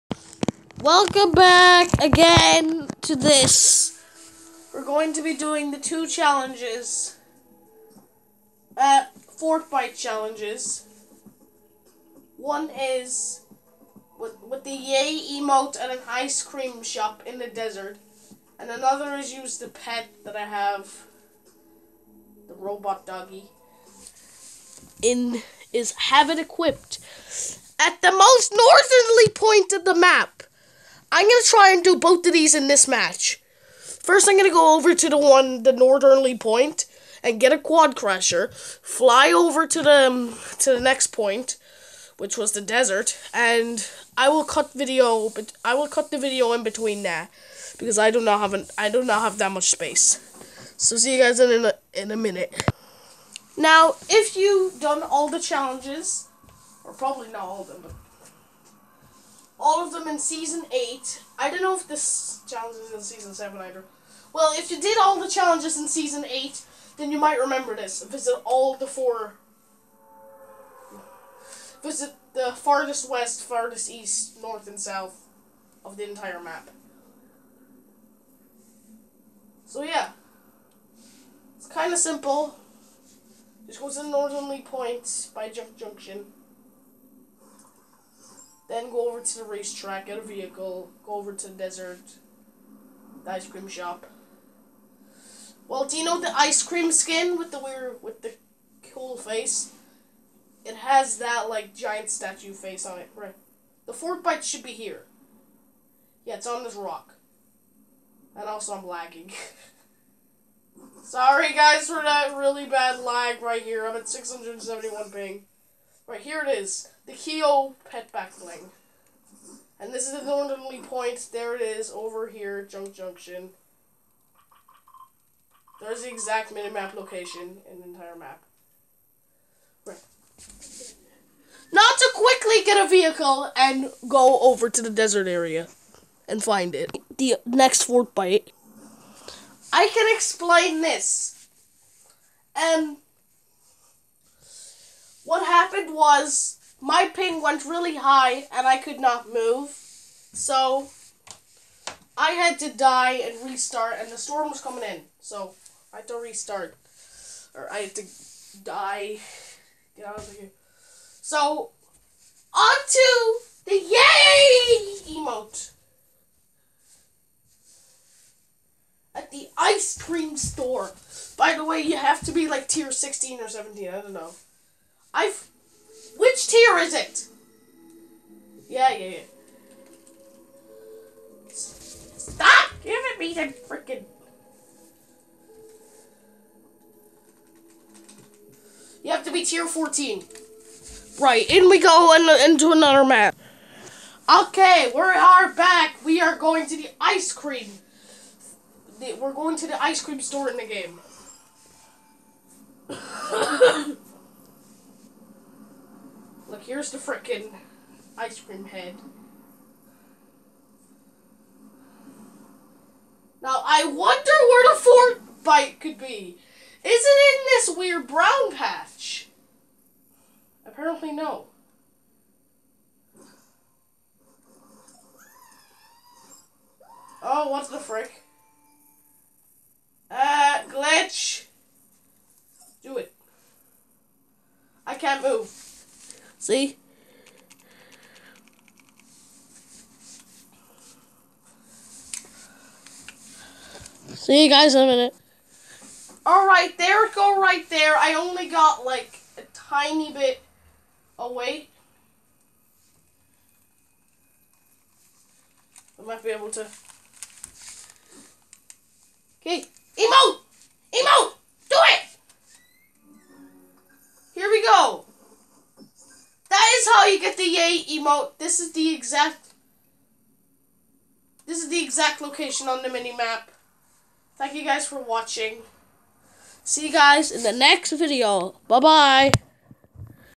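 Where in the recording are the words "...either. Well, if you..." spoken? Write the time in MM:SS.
01:03.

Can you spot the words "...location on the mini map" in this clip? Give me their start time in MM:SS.
04:32.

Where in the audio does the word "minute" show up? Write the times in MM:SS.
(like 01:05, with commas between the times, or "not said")
00:52, 04:04.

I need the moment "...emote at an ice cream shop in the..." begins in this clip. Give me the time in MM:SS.
00:15.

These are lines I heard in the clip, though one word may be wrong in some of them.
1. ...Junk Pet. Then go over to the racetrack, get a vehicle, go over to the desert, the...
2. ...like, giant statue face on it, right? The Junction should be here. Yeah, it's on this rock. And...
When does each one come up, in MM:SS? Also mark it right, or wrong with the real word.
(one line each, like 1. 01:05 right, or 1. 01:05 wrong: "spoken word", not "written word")
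1. 01:25 wrong: "Junction", not "Pet"
2. 01:41 wrong: "Fortbyte", not "Junction".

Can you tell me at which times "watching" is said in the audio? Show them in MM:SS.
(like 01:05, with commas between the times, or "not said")
04:35.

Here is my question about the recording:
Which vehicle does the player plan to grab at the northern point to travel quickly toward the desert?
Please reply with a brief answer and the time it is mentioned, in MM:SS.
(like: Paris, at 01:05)
Quad crusher, at 00:37.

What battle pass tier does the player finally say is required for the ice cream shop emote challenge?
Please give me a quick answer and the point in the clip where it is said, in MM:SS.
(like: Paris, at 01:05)
Tier 14, at 03:09.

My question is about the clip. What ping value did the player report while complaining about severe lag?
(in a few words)
671.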